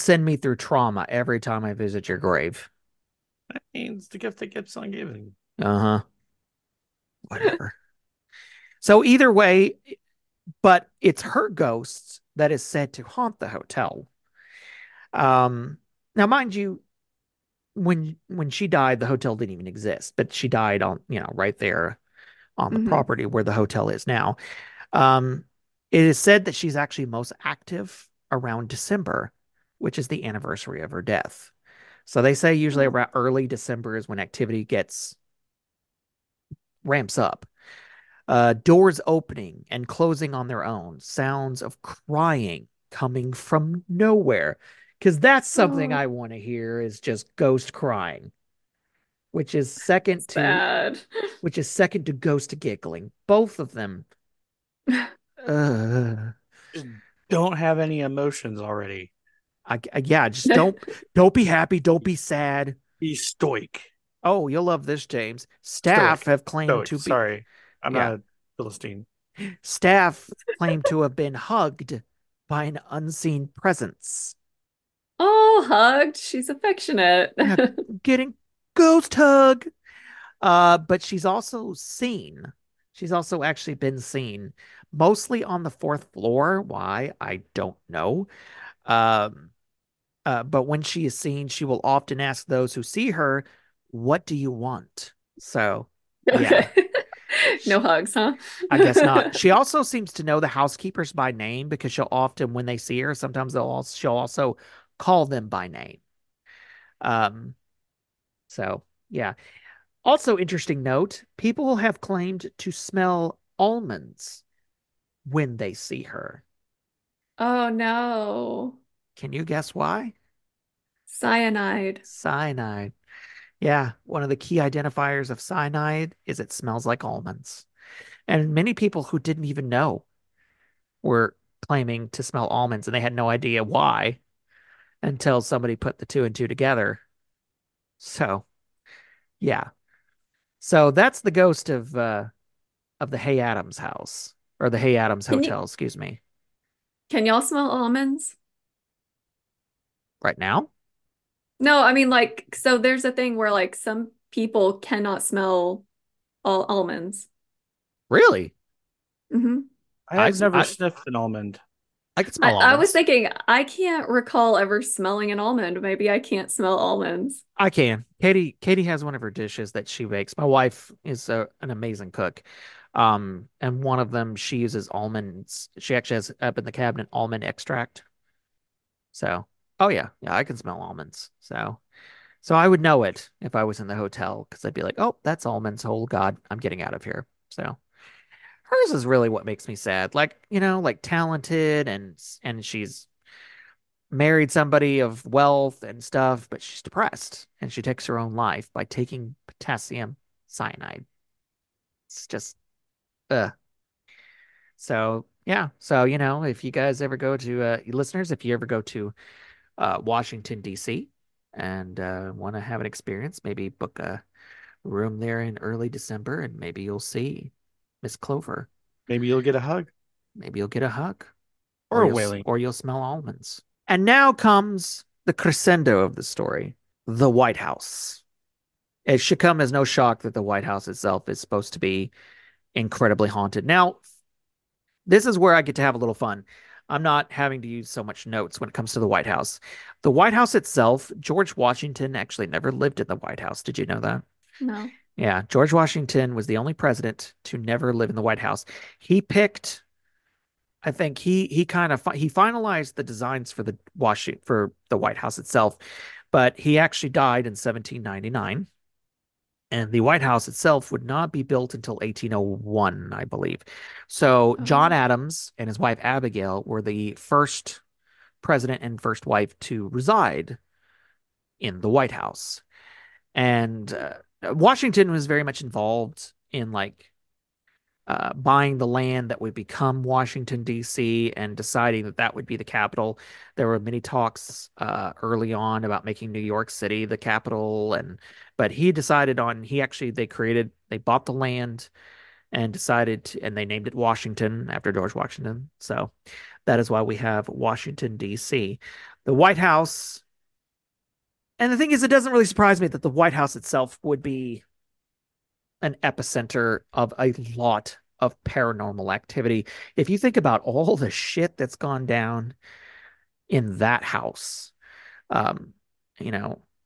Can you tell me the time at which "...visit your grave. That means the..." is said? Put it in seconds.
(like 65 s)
1 s.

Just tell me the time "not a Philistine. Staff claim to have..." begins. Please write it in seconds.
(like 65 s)
68 s.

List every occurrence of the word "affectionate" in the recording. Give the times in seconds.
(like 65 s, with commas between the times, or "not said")
76 s.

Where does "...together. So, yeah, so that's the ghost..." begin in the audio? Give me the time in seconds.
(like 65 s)
136 s.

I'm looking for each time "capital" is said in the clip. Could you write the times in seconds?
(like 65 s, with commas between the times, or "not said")
282 s, 287 s.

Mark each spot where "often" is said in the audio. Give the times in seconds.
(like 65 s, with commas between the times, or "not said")
91 s, 102 s.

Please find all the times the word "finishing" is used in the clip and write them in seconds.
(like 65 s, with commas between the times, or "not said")
not said.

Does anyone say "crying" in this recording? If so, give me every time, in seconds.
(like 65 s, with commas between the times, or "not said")
41 s, 47 s.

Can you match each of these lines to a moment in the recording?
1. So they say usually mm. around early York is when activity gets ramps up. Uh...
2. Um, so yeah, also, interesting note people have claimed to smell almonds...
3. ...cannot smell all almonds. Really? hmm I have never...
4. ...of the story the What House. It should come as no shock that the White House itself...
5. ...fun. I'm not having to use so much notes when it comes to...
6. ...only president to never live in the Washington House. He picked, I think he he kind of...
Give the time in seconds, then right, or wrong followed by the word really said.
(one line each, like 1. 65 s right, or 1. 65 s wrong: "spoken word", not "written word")
1. 32 s wrong: "December", not "York"
2. 107 s right
3. 154 s right
4. 226 s wrong: "White", not "What"
5. 236 s right
6. 246 s wrong: "White", not "Washington".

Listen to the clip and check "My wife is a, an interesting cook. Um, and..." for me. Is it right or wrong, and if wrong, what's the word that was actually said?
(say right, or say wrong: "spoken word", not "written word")
wrong: "amazing", not "interesting".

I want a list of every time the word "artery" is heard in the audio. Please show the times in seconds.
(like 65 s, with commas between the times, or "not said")
not said.